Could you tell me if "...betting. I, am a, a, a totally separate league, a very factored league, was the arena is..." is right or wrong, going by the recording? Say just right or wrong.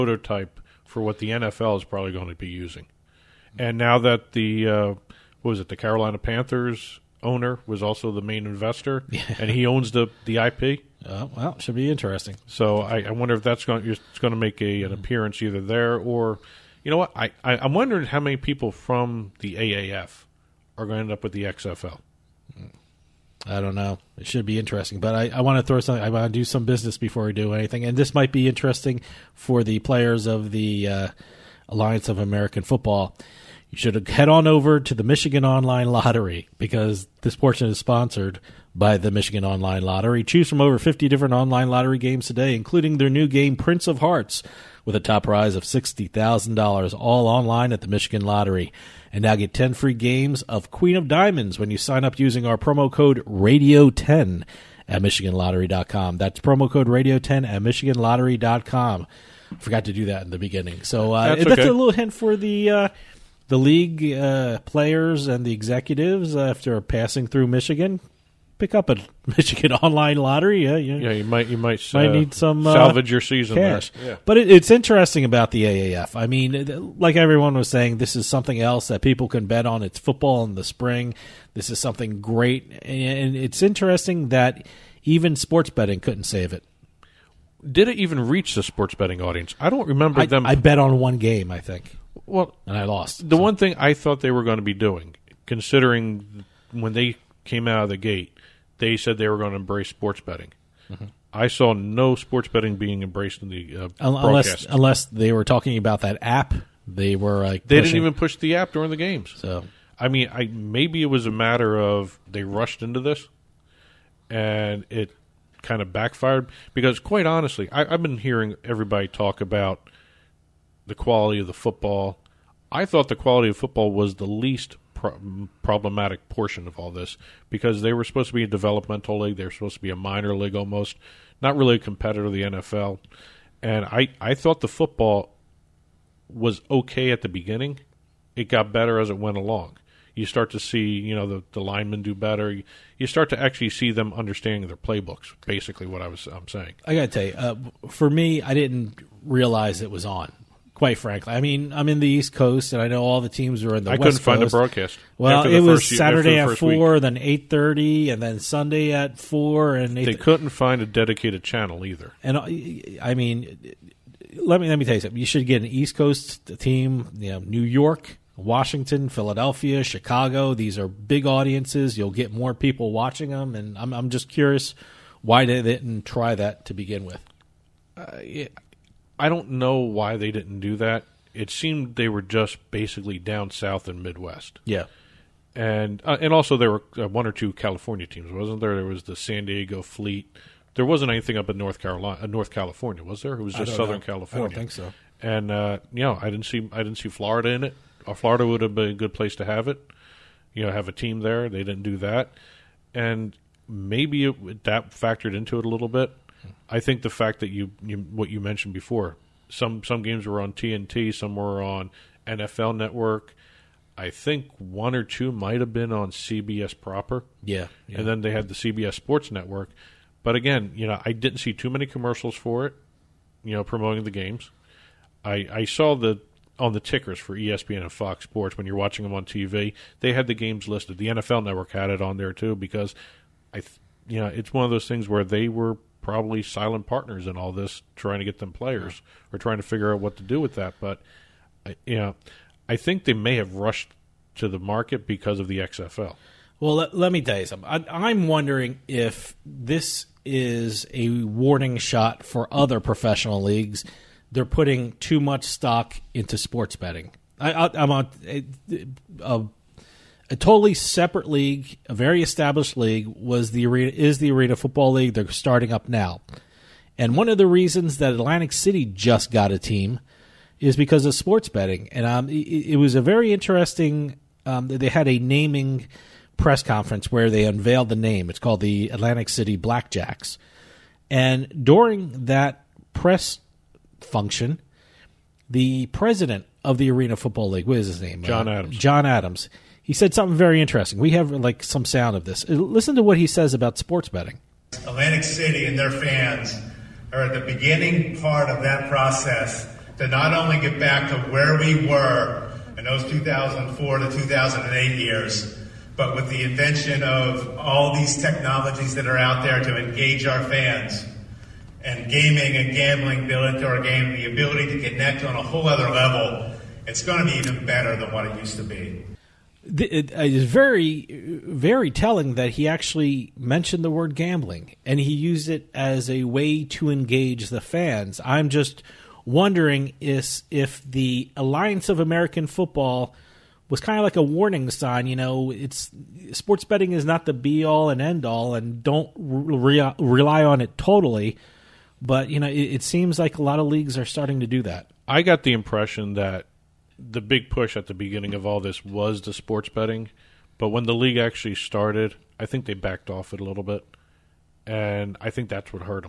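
wrong.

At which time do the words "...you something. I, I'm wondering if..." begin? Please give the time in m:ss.
4:07.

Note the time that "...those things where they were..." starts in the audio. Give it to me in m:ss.
3:54.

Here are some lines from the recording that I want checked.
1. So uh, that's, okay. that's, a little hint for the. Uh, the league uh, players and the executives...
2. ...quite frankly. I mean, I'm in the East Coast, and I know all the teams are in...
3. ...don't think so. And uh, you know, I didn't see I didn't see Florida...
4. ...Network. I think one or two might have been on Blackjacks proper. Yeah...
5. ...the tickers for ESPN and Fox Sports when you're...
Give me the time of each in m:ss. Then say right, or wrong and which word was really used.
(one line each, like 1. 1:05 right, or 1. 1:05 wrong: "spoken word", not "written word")
1. 1:00 right
2. 2:30 right
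3. 3:14 right
4. 3:32 wrong: "CBS", not "Blackjacks"
5. 3:46 right.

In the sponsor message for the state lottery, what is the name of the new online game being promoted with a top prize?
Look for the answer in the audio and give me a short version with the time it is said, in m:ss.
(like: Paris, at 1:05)
Prince of Hearts, at 0:43.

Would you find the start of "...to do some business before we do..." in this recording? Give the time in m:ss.
0:26.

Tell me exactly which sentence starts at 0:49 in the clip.
And now get 10 free games of Queen of Diamonds when you sign up using our promo code RADIO10 at MichiganLottery.com.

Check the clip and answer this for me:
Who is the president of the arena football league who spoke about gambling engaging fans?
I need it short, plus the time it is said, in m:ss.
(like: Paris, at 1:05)
John Adams, at 4:48.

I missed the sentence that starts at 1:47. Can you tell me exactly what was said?
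didn't even push the app during the games.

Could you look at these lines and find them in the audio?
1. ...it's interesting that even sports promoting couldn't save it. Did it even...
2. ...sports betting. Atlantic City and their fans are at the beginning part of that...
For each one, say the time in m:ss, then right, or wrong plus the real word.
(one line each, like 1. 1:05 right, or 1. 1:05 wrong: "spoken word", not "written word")
1. 1:23 wrong: "betting", not "promoting"
2. 4:53 right.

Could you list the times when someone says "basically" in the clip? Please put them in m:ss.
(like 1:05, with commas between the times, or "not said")
2:25, 3:02.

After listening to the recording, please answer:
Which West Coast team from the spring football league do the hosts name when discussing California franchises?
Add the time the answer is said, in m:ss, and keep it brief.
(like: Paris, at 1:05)
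San Diego Fleet, at 3:09.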